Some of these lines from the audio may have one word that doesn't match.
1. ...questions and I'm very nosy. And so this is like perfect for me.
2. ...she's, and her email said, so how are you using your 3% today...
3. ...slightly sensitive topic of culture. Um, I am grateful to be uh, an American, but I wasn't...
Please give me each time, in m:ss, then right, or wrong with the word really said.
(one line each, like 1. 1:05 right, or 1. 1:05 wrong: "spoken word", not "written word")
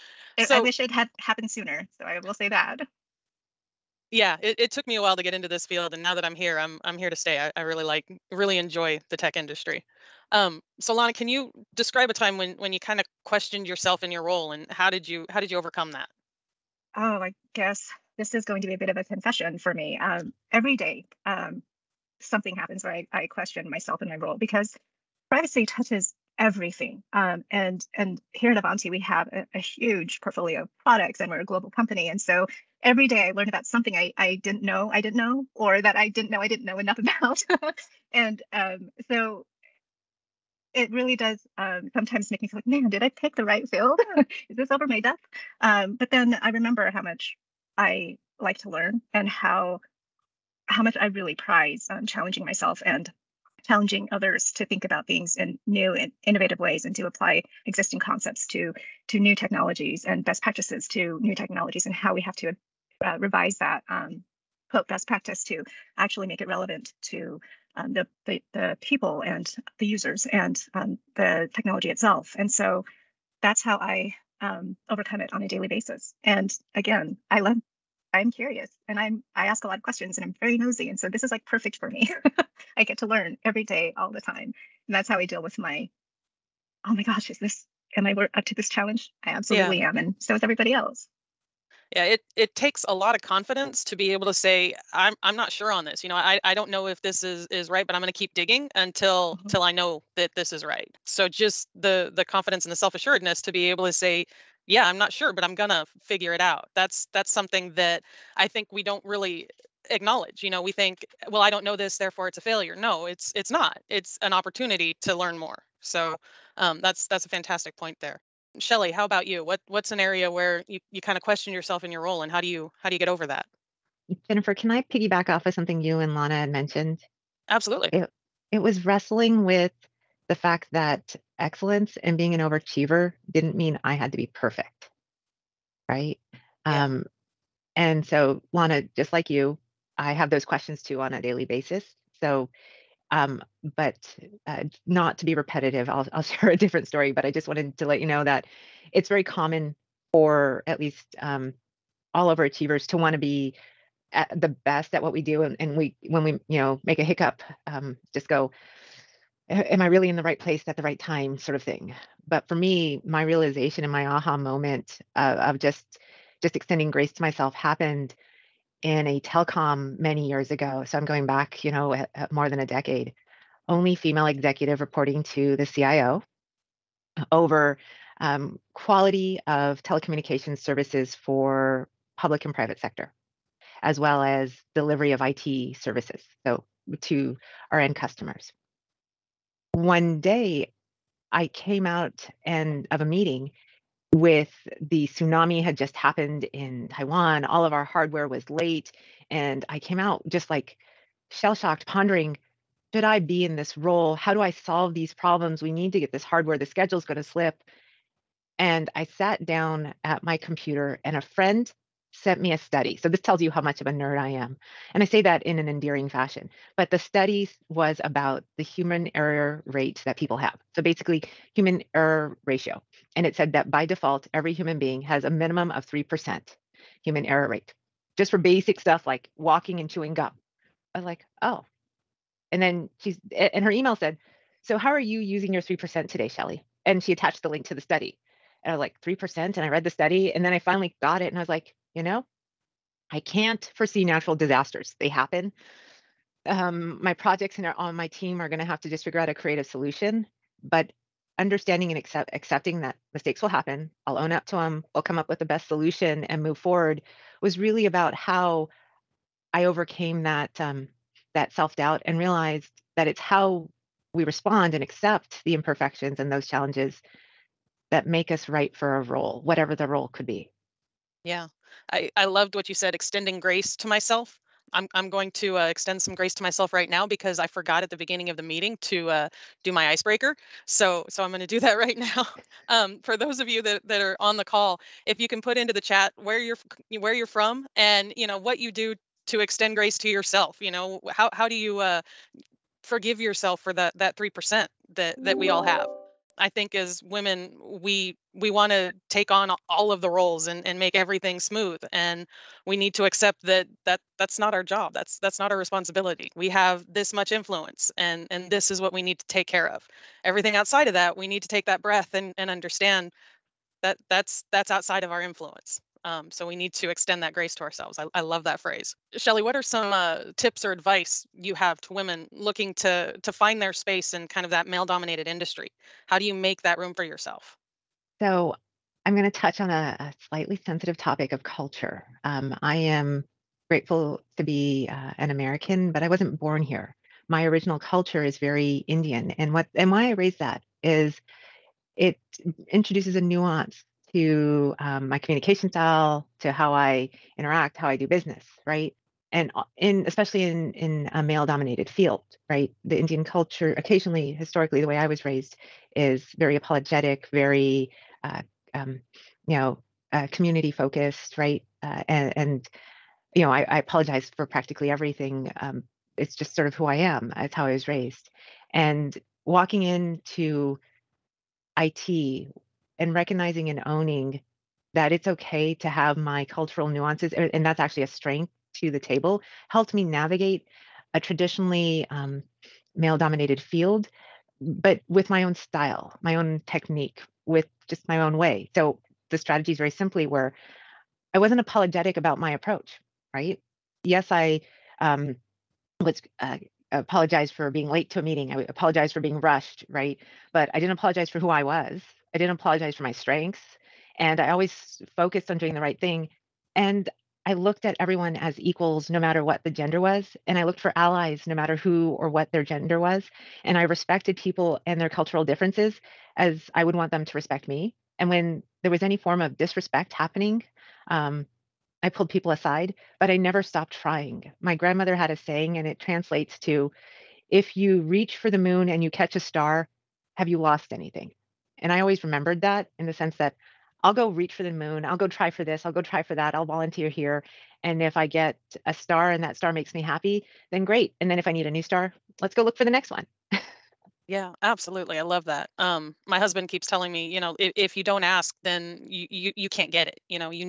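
1. 1:19 right
2. 3:52 right
3. 5:30 right.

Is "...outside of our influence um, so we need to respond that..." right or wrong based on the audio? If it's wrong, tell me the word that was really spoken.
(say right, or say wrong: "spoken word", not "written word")
wrong: "extend", not "respond".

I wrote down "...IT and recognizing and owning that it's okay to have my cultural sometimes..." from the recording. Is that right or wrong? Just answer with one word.
wrong.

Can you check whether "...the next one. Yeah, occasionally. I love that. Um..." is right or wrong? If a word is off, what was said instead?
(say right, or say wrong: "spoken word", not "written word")
wrong: "absolutely", not "occasionally".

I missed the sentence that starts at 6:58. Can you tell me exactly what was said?
And when there was any form of disrespect happening, um, I pulled people aside, but I never stopped trying.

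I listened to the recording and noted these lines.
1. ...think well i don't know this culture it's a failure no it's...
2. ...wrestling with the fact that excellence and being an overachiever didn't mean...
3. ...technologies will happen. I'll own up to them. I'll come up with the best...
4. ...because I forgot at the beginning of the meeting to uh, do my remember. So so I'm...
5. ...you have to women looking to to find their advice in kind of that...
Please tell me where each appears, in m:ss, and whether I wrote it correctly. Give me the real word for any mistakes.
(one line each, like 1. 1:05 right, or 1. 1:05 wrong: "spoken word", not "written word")
1. 1:50 wrong: "therefore", not "culture"
2. 2:08 right
3. 4:13 wrong: "mistakes", not "technologies"
4. 4:37 wrong: "icebreaker", not "remember"
5. 5:21 wrong: "space", not "advice".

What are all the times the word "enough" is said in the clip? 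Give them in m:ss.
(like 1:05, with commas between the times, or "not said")
0:36.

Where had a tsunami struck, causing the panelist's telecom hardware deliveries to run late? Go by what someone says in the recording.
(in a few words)
Taiwan.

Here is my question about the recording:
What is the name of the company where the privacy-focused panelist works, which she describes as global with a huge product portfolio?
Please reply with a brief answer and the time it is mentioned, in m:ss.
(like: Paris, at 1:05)
Ivanti, at 0:28.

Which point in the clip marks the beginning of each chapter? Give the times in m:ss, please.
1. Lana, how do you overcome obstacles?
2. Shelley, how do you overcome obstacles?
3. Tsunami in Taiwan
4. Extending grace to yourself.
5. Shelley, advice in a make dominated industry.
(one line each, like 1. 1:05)
1. 0:17
2. 2:04
3. 3:09
4. 4:33
5. 5:27.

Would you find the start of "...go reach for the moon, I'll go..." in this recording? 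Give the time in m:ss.
7:14.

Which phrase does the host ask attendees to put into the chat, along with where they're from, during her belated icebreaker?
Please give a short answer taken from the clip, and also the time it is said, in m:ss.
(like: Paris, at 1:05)
extend grace to yourself, at 4:49.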